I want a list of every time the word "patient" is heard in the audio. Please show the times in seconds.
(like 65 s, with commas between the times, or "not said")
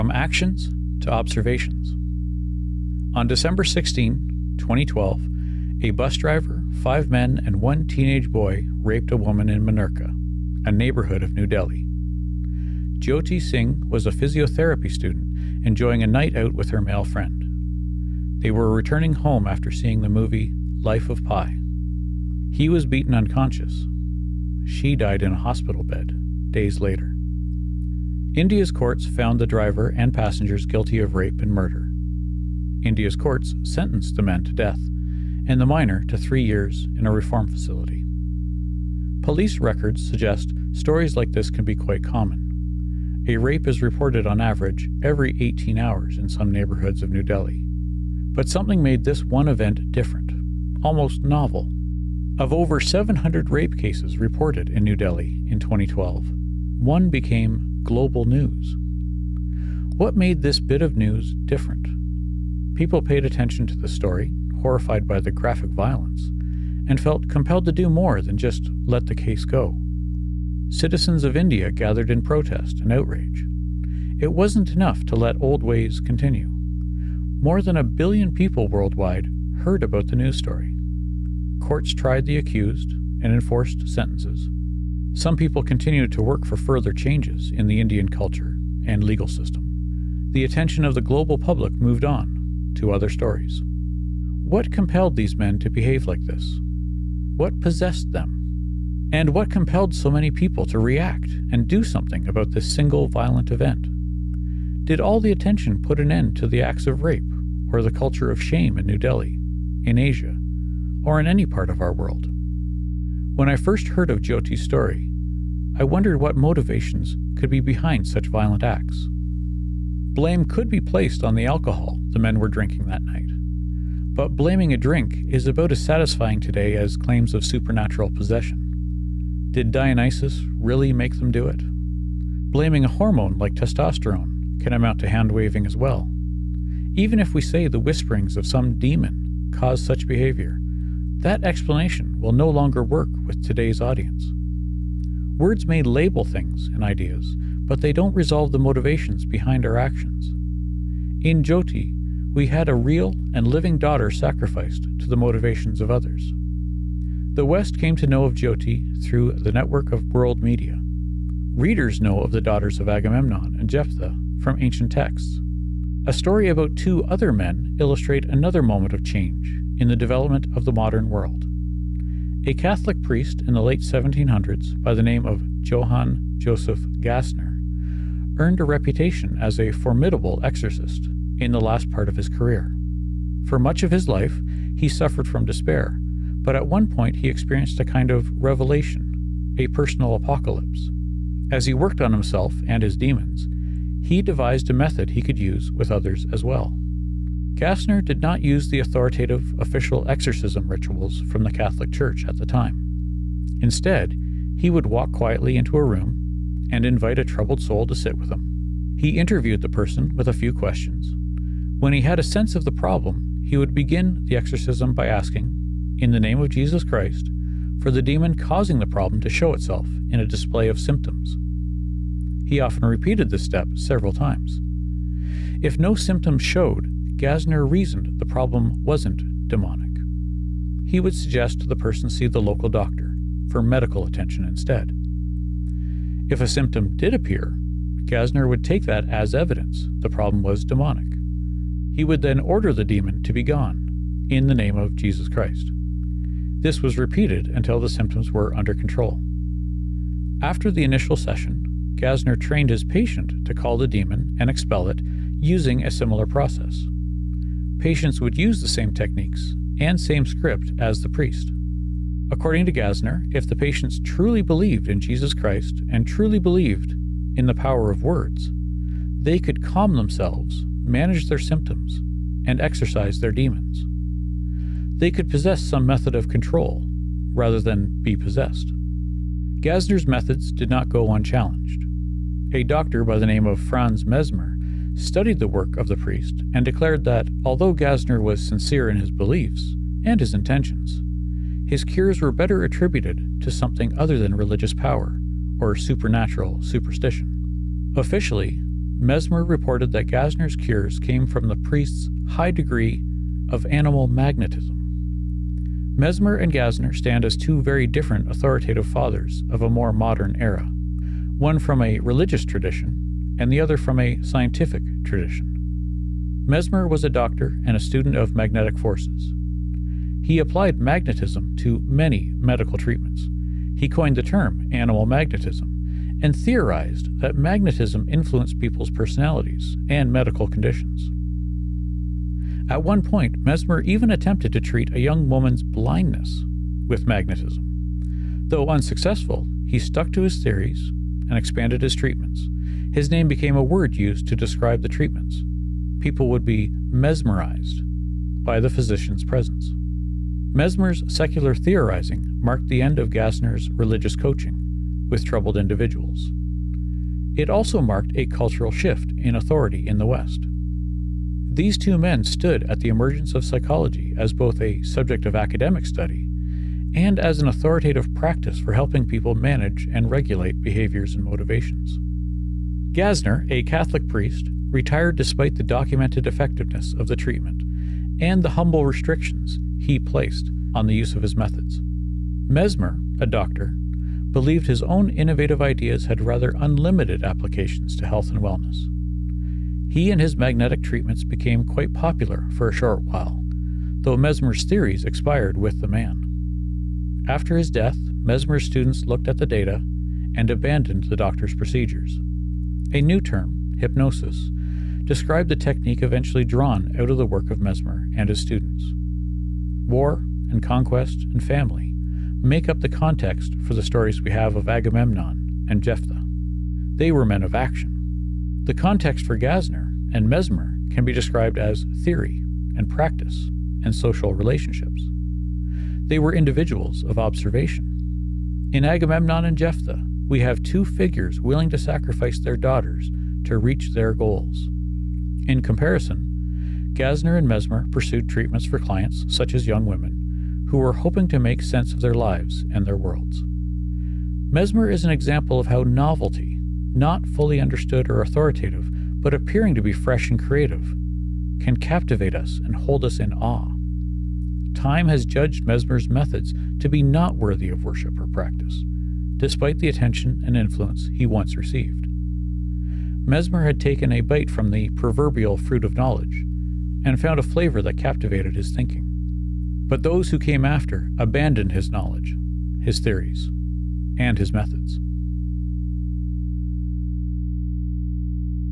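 252 s, 257 s, 263 s.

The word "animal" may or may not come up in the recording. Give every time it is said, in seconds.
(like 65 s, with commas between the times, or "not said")
303 s, 324 s.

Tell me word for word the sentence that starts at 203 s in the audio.
Instead, he would walk quietly into a room and invite a troubled soul to sit with him.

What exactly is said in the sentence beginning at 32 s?
India's courts sentenced the men to death and the minor to three years in a reform facility.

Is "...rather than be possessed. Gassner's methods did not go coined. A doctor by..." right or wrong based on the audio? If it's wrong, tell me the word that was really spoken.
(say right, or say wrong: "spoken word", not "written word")
wrong: "unchallenged", not "coined".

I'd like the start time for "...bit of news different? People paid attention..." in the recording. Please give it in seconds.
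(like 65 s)
60 s.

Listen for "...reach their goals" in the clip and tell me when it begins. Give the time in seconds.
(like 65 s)
433 s.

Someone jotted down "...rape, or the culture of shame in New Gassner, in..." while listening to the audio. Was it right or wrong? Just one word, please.
wrong.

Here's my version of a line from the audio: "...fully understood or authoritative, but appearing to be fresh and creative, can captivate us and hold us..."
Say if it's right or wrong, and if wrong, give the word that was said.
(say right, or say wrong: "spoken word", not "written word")
right.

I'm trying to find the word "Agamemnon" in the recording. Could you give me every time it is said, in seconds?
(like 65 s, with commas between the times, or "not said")
162 s, 414 s, 428 s.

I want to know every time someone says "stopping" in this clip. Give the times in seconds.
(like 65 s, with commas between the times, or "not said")
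not said.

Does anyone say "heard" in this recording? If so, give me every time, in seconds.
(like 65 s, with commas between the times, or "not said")
79 s, 113 s.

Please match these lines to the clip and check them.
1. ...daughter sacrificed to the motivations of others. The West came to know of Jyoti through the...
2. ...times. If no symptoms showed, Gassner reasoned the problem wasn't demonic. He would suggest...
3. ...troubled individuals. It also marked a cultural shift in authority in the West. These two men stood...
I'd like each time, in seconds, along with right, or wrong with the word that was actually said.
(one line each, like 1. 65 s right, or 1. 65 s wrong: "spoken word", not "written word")
1. 153 s right
2. 224 s right
3. 355 s right.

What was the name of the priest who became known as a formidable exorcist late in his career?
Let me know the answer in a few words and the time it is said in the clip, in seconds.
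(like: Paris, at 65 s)
Johann Joseph Gassner, at 175 s.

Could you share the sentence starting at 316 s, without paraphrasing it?
Mesmer was a doctor and a student of magnetic forces.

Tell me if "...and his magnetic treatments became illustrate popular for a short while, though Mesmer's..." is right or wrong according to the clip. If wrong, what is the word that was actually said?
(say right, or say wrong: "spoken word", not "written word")
wrong: "quite", not "illustrate".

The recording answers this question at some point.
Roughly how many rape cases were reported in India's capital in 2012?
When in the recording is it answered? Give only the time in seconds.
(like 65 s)
52 s.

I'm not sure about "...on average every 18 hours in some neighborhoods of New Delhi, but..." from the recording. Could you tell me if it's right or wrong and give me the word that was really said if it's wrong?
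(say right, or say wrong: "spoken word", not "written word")
right.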